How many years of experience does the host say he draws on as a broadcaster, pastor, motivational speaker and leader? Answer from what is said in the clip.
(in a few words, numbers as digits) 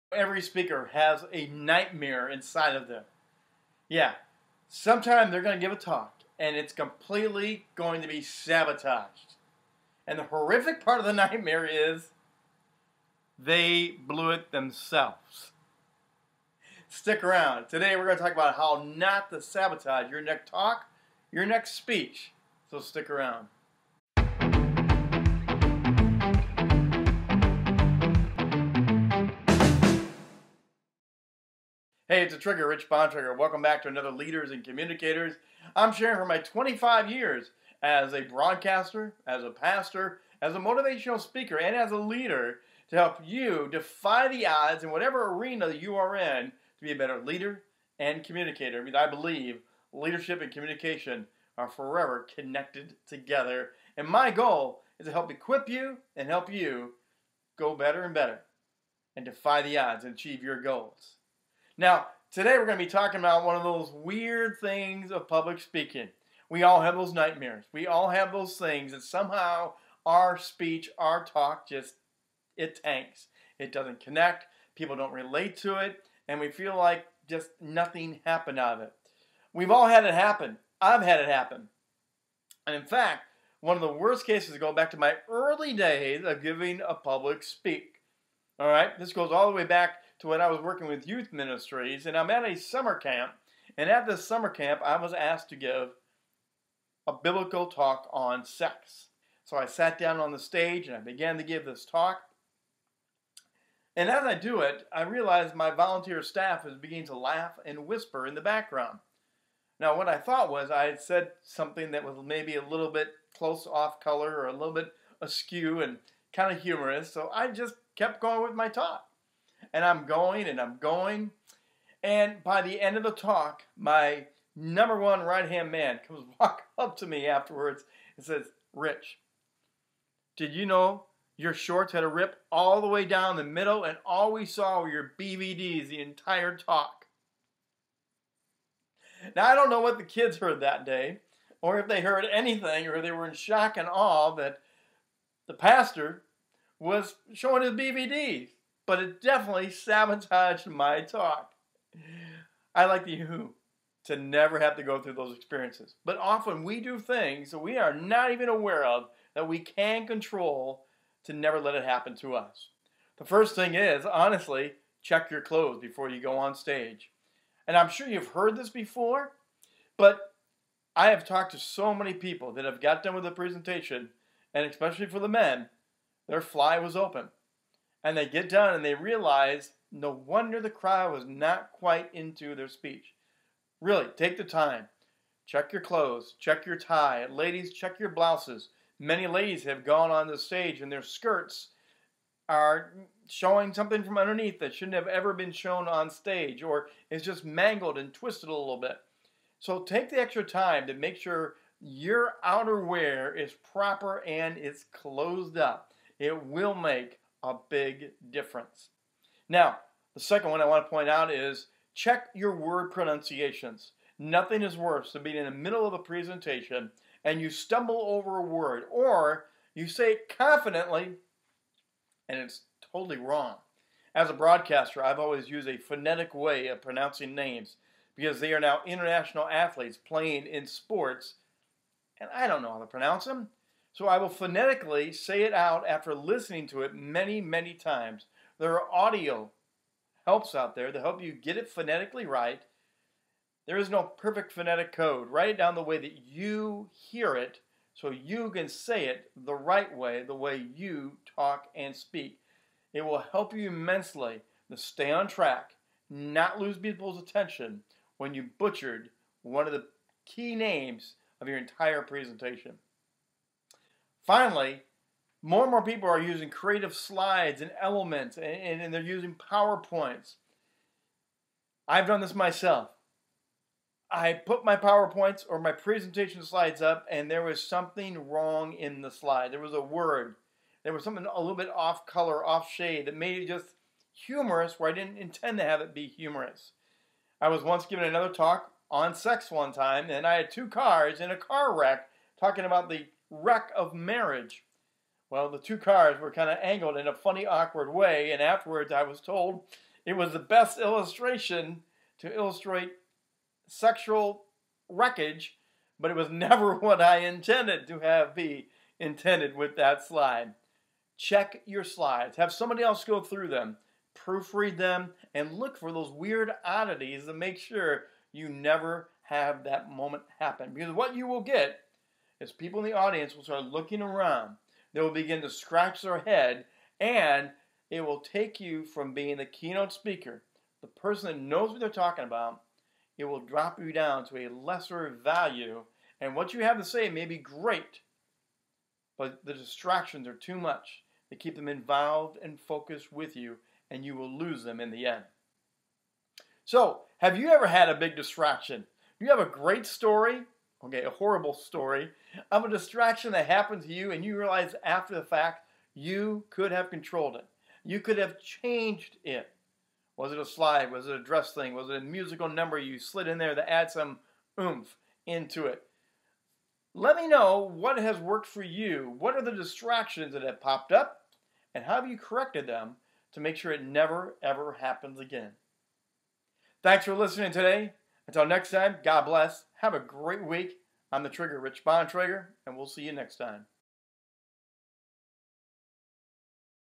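25.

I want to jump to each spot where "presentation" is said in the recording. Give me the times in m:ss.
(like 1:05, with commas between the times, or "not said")
2:53, 3:35, 4:22, 4:35.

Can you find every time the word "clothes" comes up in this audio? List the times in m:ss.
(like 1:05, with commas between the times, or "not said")
2:45, 3:05.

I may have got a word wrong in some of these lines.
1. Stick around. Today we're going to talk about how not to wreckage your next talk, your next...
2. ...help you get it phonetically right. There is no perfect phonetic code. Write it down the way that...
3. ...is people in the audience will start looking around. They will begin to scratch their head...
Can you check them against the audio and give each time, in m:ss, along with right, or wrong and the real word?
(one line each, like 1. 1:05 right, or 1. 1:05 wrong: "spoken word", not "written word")
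1. 0:16 wrong: "sabotage", not "wreckage"
2. 4:01 right
3. 5:22 right.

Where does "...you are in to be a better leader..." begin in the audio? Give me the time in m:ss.
0:45.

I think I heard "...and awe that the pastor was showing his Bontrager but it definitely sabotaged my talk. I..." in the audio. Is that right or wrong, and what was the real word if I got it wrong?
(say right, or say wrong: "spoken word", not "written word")
wrong: "BVDs", not "Bontrager".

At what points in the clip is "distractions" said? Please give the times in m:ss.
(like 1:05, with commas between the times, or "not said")
5:39, 5:48, 5:52, 6:09.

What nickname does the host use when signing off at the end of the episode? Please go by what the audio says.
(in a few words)
the Trigger.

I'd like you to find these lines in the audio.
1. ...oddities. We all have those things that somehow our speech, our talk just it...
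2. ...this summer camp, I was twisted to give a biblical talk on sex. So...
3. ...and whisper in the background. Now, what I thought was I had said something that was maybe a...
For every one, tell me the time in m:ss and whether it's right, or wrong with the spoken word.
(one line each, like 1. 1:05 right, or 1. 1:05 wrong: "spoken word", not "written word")
1. 1:07 wrong: "nightmares", not "oddities"
2. 1:34 wrong: "asked", not "twisted"
3. 1:47 right.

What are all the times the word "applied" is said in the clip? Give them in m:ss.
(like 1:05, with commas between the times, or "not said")
not said.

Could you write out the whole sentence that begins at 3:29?
Now, the second one I want to point out is check your word pronunciations.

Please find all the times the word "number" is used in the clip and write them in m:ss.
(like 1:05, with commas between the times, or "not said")
2:04, 6:02.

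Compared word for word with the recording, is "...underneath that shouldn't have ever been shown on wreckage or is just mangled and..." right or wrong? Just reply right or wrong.
wrong.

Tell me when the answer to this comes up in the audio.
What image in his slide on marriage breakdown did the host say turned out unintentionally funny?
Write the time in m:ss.
4:50.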